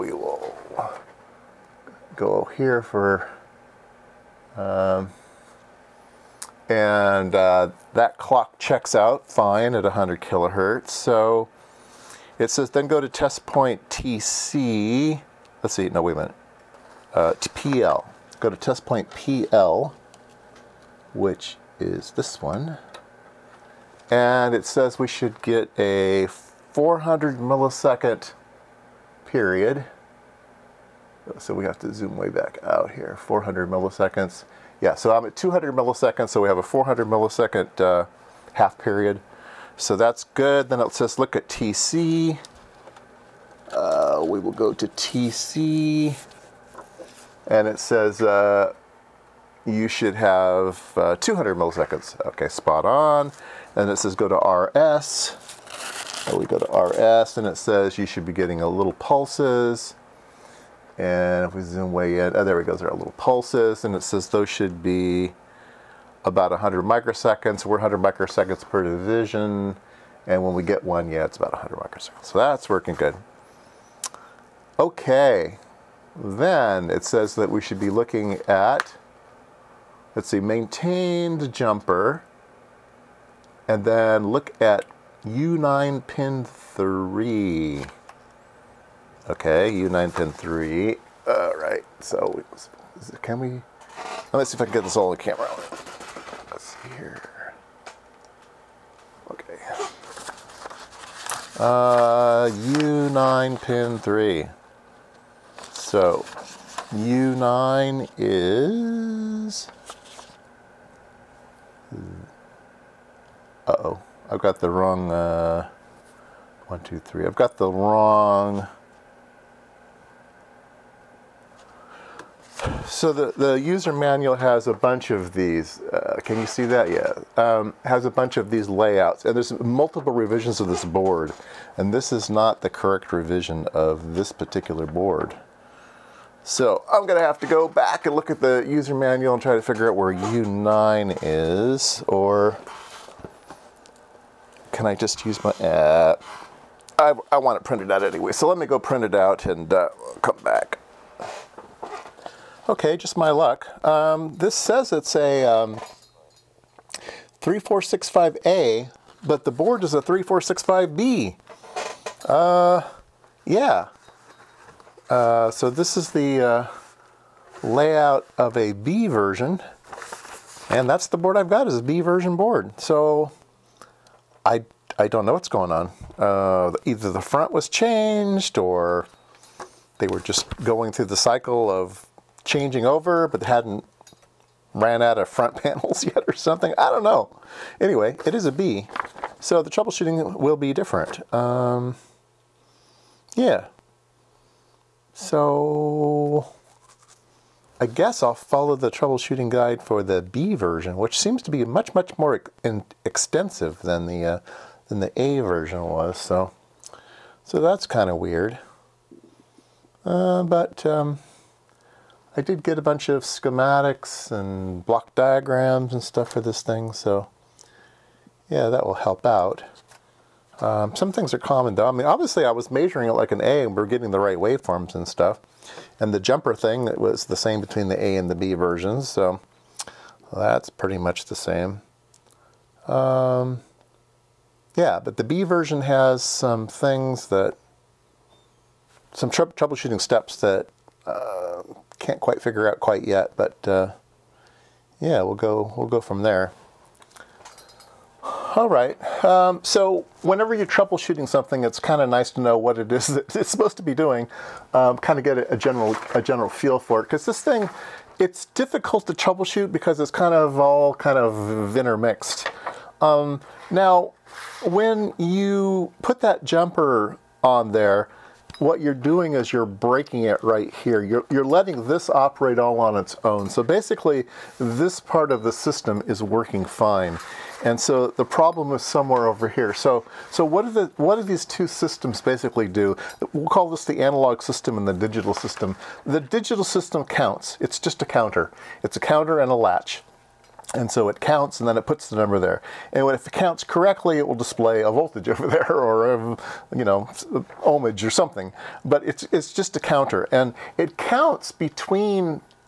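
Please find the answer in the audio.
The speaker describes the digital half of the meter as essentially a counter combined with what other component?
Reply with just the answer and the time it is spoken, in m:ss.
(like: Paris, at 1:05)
A latch, at 4:49.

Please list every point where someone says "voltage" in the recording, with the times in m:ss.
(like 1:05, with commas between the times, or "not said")
4:54.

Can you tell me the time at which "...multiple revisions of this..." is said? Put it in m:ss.
2:09.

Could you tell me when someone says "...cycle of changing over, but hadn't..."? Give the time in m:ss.
3:01.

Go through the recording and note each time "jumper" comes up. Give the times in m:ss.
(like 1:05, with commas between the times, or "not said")
1:21, 3:46, 4:26.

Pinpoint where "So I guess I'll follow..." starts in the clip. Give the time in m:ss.
3:15.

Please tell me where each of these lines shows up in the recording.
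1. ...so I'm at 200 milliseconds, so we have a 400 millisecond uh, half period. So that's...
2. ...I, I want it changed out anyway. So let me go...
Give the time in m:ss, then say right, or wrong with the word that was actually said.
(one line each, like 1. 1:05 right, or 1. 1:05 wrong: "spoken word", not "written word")
1. 0:34 right
2. 2:26 wrong: "printed", not "changed".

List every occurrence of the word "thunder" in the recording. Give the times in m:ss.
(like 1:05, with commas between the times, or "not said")
not said.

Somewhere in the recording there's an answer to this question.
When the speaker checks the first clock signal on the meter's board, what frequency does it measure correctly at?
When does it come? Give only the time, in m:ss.
0:09.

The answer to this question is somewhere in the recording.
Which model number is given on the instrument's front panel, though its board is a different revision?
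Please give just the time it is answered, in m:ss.
2:37.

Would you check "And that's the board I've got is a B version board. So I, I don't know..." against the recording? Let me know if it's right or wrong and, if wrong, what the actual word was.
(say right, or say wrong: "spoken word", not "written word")
right.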